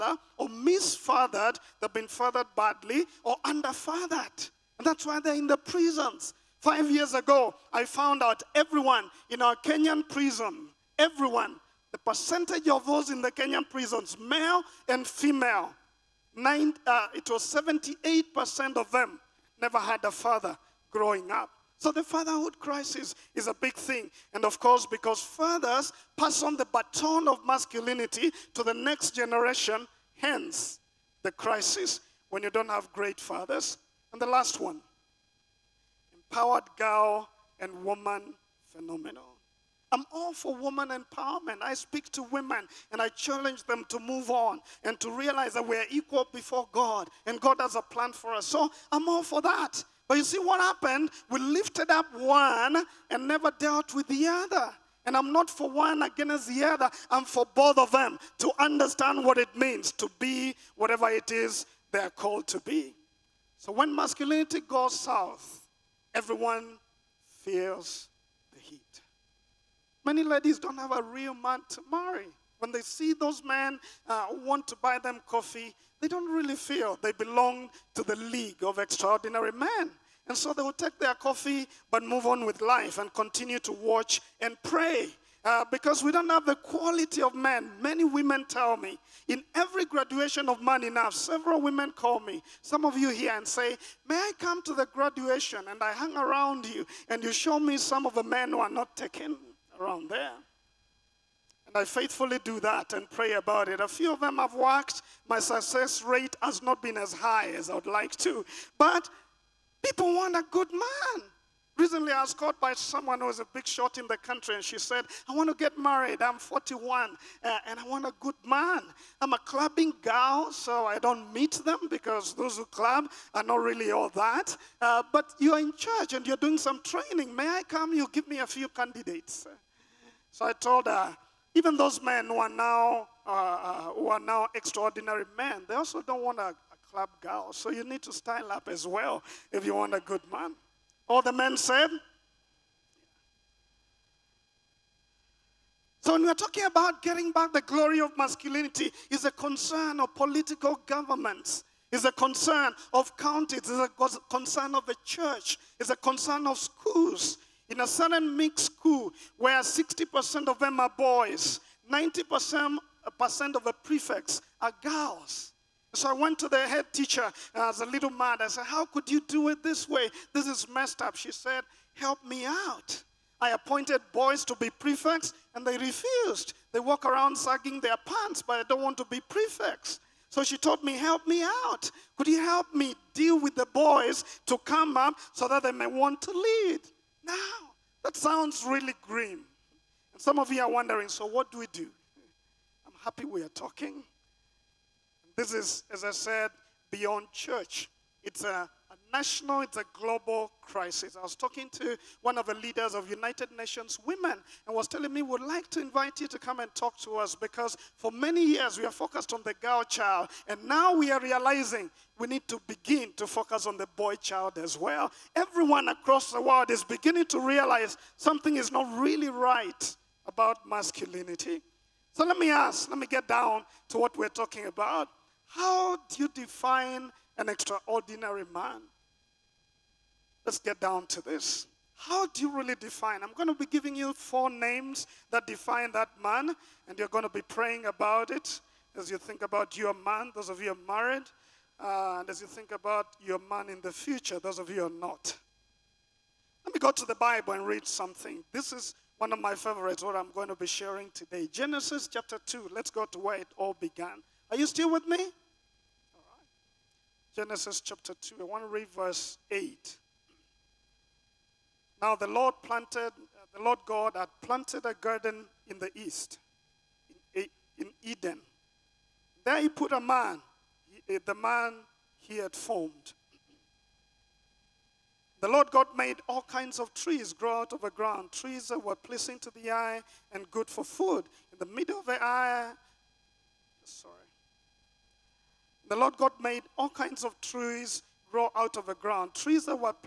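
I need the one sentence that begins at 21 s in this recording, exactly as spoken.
So the fatherhood crisis is a big thing.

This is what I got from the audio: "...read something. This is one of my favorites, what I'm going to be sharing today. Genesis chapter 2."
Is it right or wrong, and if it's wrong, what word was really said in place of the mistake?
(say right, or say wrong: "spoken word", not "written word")
right.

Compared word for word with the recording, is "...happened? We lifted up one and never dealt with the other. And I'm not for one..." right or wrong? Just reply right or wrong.
right.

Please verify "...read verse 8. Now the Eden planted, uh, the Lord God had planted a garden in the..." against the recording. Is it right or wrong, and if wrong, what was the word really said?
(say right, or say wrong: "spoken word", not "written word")
wrong: "Lord", not "Eden".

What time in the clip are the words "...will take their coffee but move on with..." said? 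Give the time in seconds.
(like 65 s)
80 s.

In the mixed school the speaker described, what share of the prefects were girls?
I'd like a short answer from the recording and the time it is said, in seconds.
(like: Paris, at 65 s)
90%, at 161 s.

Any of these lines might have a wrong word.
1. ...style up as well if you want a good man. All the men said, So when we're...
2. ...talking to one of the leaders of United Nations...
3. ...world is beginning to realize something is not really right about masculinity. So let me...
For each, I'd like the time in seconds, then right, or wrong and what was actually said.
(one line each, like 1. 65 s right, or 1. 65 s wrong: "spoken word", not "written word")
1. 138 s right
2. 201 s right
3. 216 s right.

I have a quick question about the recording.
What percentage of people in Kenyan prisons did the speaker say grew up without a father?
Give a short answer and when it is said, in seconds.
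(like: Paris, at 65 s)
78%, at 17 s.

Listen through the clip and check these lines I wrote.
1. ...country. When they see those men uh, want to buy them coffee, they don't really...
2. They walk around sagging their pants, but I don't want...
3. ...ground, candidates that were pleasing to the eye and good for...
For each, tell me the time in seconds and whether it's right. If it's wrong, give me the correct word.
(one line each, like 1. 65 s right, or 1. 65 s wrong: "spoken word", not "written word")
1. 71 s wrong: "marry", not "country"
2. 176 s right
3. 277 s wrong: "trees", not "candidates".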